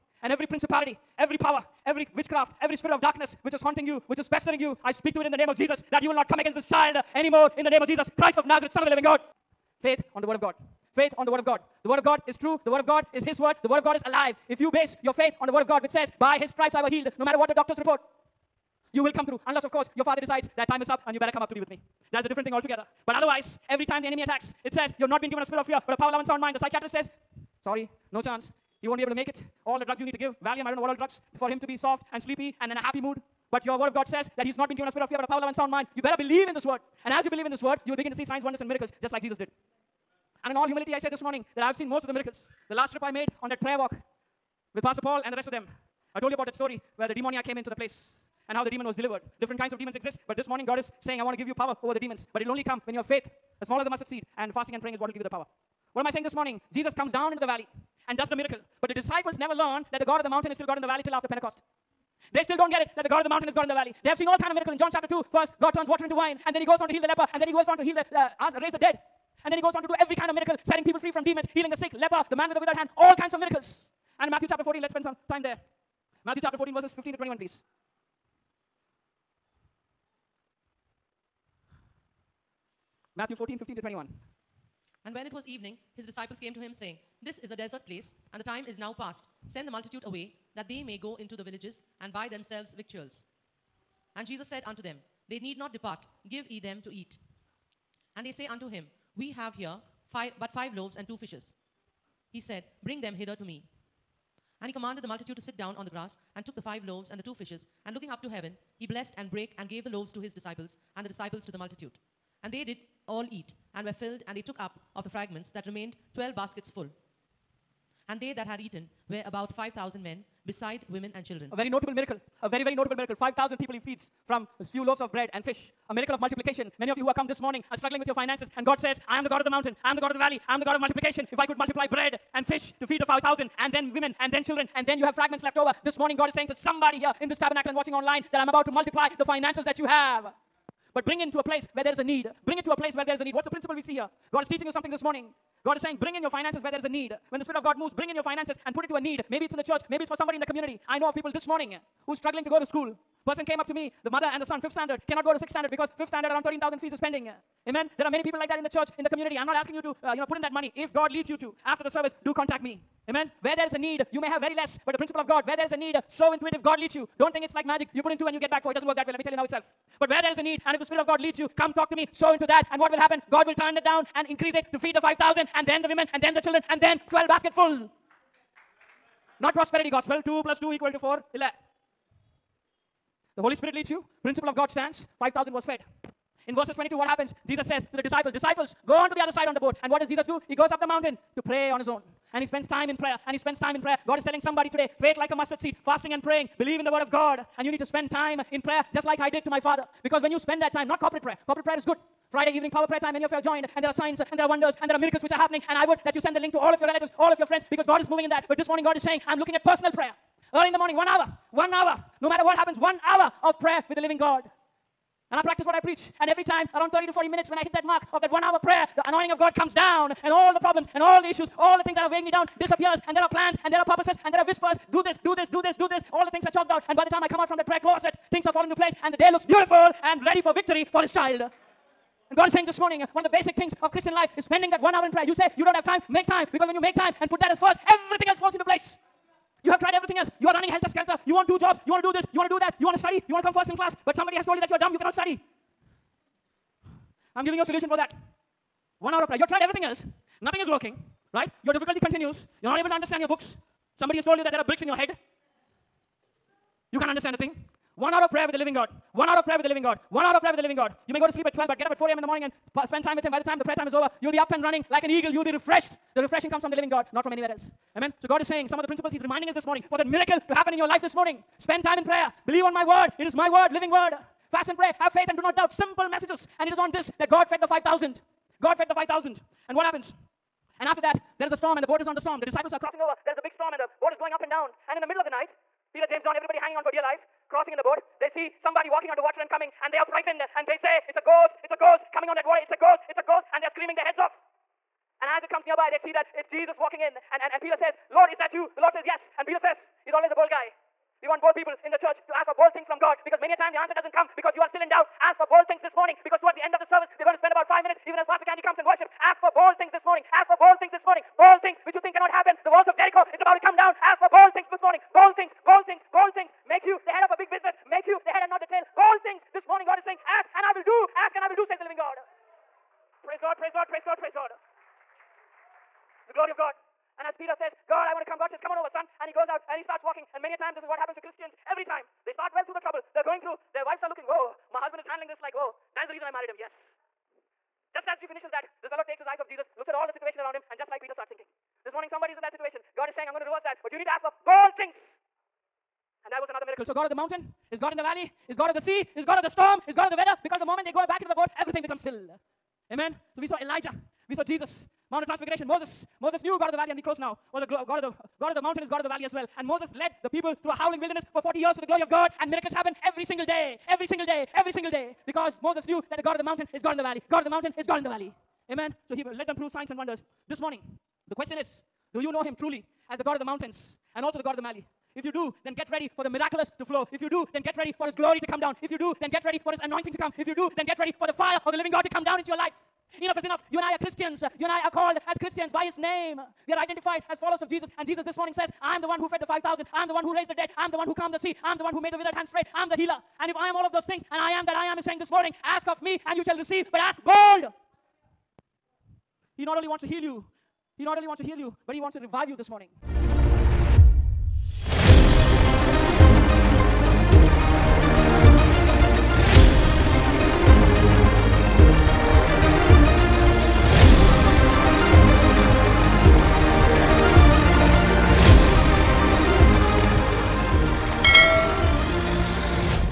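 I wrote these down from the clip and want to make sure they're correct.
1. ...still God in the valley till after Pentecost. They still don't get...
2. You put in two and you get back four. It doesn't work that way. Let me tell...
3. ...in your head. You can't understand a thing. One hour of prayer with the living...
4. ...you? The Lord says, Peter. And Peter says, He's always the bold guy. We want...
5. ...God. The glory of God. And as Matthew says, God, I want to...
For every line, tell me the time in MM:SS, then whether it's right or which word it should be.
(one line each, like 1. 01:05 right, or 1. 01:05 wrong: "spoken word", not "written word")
1. 01:00 right
2. 02:47 right
3. 04:14 right
4. 04:58 wrong: "Yes", not "Peter"
5. 05:24 wrong: "Peter", not "Matthew".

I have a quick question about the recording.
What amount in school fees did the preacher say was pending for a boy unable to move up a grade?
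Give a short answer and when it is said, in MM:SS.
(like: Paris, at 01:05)
13,000, at 02:36.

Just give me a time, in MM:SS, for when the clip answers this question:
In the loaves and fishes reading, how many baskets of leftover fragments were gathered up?
01:56.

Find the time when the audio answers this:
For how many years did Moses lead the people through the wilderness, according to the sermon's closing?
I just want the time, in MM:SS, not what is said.
06:01.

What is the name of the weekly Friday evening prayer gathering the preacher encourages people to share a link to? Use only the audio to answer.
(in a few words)
Power prayer time.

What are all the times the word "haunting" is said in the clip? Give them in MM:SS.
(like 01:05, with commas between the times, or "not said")
00:03.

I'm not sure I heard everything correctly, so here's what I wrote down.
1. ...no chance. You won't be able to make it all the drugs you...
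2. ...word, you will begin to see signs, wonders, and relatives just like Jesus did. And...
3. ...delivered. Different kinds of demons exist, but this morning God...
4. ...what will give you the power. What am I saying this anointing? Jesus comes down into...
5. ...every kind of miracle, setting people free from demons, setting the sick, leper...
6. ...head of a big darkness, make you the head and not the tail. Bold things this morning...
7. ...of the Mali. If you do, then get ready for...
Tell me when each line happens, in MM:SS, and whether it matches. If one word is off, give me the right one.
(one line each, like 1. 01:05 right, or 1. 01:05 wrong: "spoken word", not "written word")
1. 00:28 right
2. 00:37 wrong: "miracles", not "relatives"
3. 00:48 right
4. 00:54 wrong: "morning", not "anointing"
5. 01:09 wrong: "healing", not "setting"
6. 05:17 wrong: "business", not "darkness"
7. 06:14 right.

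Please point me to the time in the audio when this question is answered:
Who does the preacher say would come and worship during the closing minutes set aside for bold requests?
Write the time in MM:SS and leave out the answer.
05:08.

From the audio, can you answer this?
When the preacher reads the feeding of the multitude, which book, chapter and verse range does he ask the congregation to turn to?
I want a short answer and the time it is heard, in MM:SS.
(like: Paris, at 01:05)
Matthew 14, 15 to 21, at 01:23.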